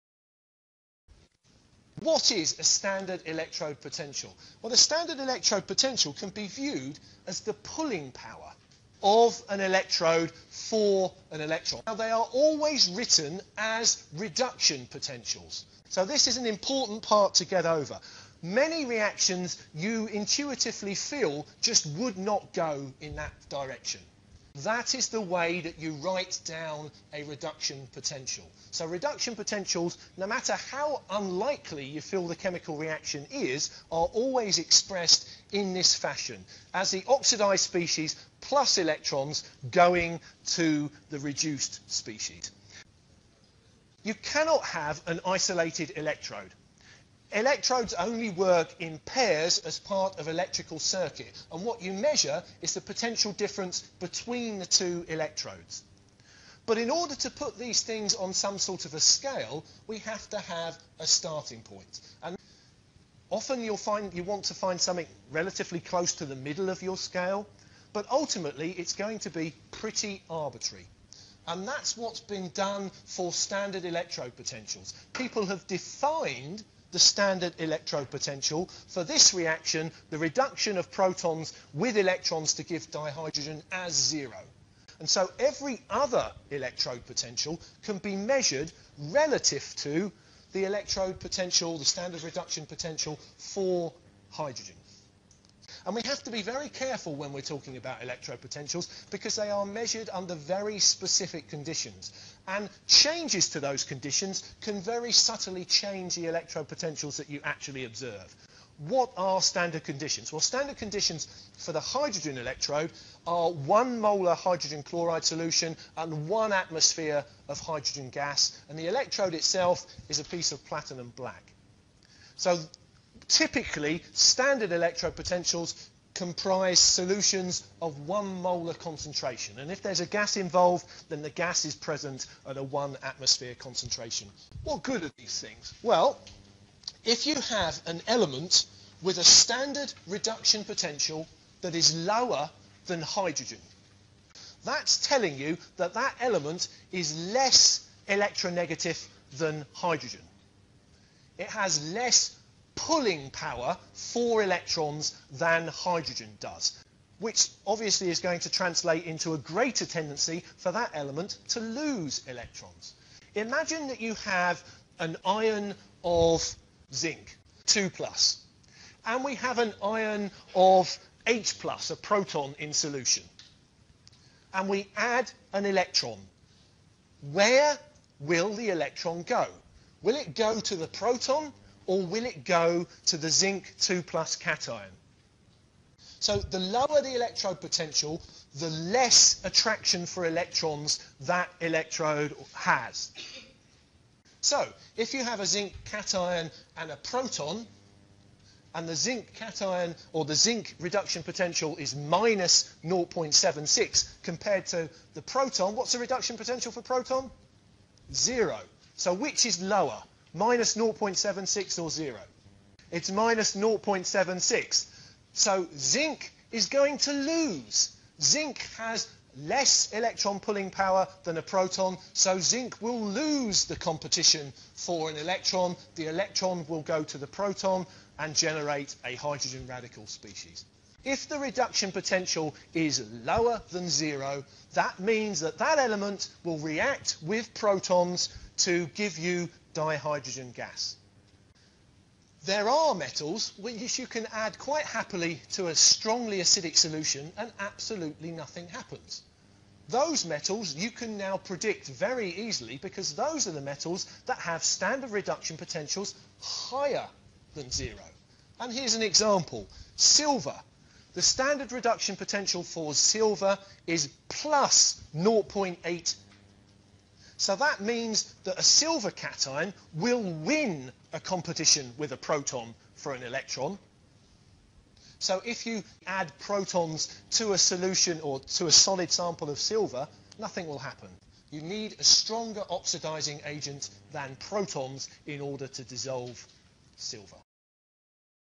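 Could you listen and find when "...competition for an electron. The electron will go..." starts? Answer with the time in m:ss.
3:43.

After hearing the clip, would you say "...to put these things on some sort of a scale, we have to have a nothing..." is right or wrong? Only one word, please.
wrong.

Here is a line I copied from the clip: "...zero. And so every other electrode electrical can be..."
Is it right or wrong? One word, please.
wrong.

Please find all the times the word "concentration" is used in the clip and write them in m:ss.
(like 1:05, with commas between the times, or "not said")
2:08, 2:13.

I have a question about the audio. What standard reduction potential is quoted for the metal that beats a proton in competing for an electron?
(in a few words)
+0.8.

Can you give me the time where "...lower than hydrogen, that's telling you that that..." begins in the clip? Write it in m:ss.
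2:22.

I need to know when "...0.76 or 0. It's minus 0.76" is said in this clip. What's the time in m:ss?
3:30.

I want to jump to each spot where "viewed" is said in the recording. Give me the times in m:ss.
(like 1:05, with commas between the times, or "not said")
0:06.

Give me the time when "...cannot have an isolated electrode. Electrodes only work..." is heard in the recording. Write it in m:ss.
0:44.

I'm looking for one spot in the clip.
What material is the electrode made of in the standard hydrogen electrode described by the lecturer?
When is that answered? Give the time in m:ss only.
2:00.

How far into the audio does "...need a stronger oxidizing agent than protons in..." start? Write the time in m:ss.
4:41.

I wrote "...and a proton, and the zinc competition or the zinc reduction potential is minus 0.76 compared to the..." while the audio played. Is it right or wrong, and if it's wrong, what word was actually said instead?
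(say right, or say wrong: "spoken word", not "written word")
wrong: "cation", not "competition".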